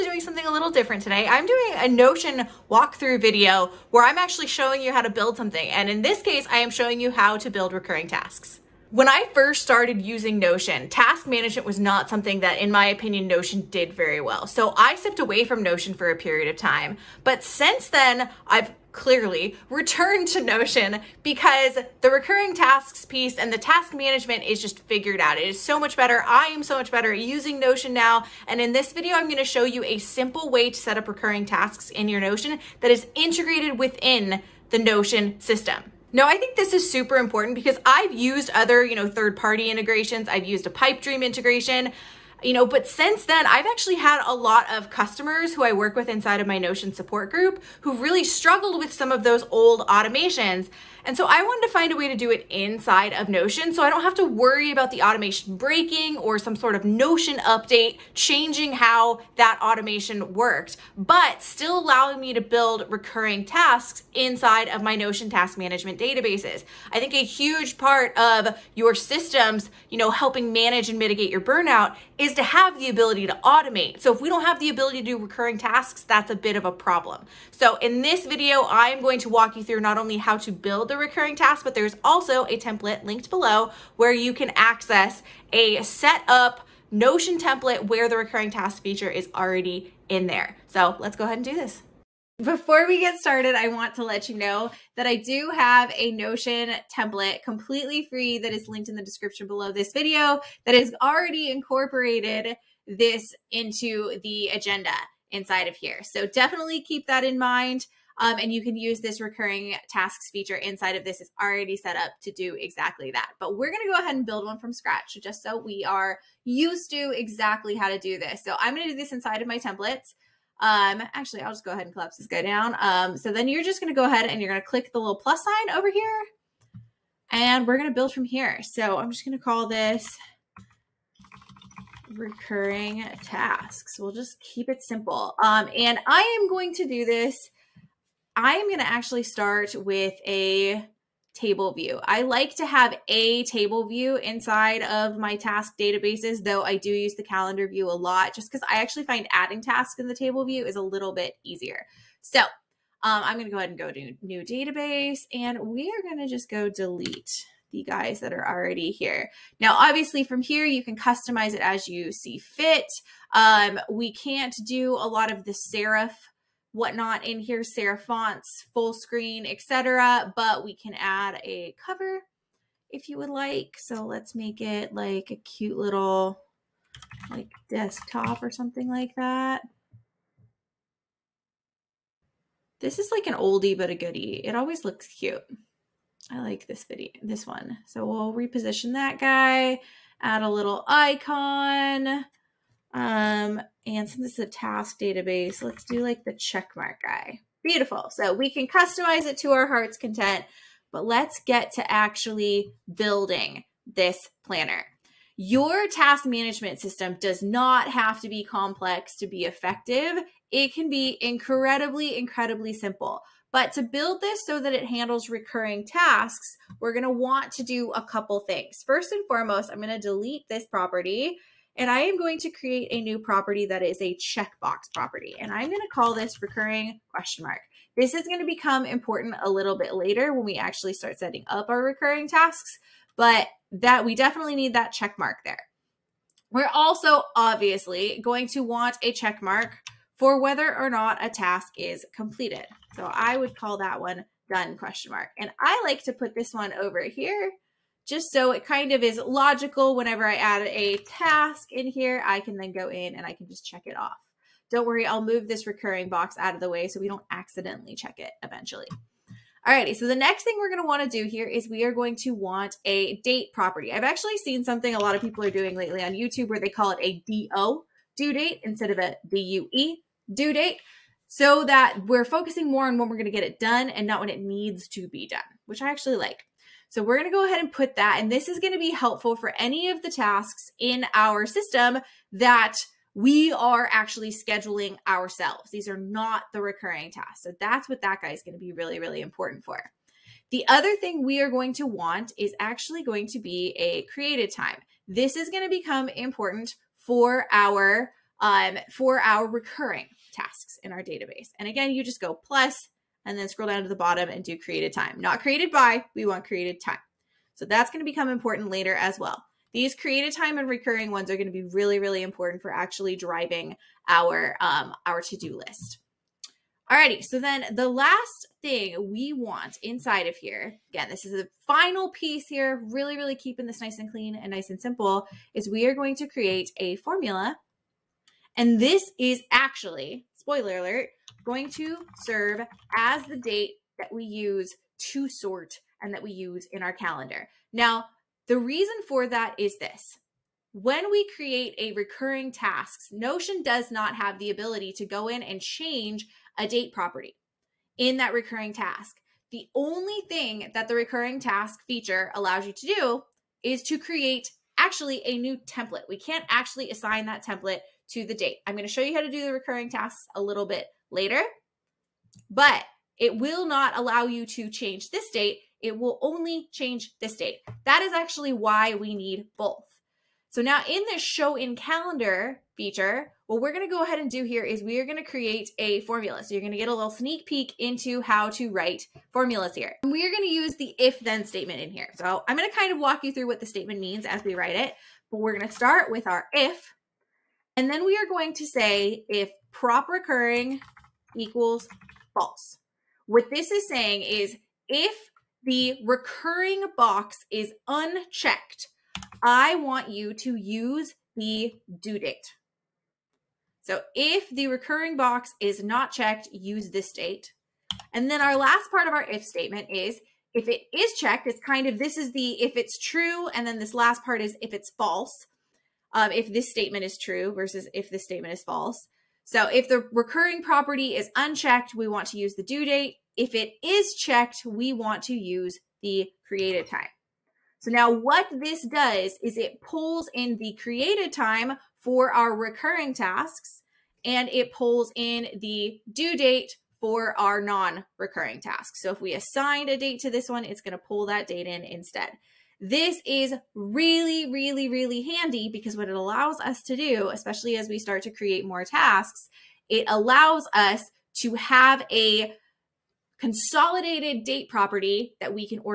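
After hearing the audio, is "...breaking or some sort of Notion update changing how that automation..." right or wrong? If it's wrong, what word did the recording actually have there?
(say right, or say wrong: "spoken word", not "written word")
right.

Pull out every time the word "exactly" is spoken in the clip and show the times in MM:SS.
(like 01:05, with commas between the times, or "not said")
01:52, 01:57.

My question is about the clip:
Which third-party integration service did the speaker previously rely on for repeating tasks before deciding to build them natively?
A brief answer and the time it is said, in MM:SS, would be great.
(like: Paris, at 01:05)
Pipedream, at 00:40.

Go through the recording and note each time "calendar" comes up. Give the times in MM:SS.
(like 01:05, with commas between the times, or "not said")
02:27, 05:36, 06:11.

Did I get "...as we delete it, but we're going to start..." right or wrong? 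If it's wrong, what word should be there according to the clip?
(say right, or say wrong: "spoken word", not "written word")
wrong: "write", not "delete".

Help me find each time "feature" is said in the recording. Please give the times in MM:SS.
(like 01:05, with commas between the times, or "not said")
01:28, 01:50, 05:51, 06:12.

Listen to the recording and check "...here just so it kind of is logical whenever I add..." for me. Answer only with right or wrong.
right.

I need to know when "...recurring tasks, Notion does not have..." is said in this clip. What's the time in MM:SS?
05:41.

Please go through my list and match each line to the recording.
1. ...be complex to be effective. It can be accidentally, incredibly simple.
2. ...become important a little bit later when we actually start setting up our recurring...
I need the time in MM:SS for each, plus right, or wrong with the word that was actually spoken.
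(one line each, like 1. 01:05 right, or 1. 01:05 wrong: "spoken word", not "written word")
1. 03:28 wrong: "incredibly", not "accidentally"
2. 03:48 right.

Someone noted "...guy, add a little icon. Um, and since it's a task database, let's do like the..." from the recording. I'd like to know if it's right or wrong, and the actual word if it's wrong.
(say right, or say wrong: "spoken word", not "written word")
right.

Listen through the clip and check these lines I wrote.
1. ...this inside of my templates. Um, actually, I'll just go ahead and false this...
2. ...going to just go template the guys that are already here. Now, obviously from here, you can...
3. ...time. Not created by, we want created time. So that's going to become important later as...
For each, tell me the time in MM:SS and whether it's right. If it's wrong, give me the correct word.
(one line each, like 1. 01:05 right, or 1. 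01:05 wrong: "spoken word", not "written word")
1. 01:58 wrong: "collapse", not "false"
2. 02:36 wrong: "delete", not "template"
3. 05:04 right.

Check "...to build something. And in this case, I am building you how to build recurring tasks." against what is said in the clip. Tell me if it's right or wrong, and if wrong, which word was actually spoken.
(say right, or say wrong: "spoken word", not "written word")
wrong: "showing", not "building".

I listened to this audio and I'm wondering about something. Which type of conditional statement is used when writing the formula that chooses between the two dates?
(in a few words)
if then statement.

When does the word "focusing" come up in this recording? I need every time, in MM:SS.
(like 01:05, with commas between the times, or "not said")
04:32.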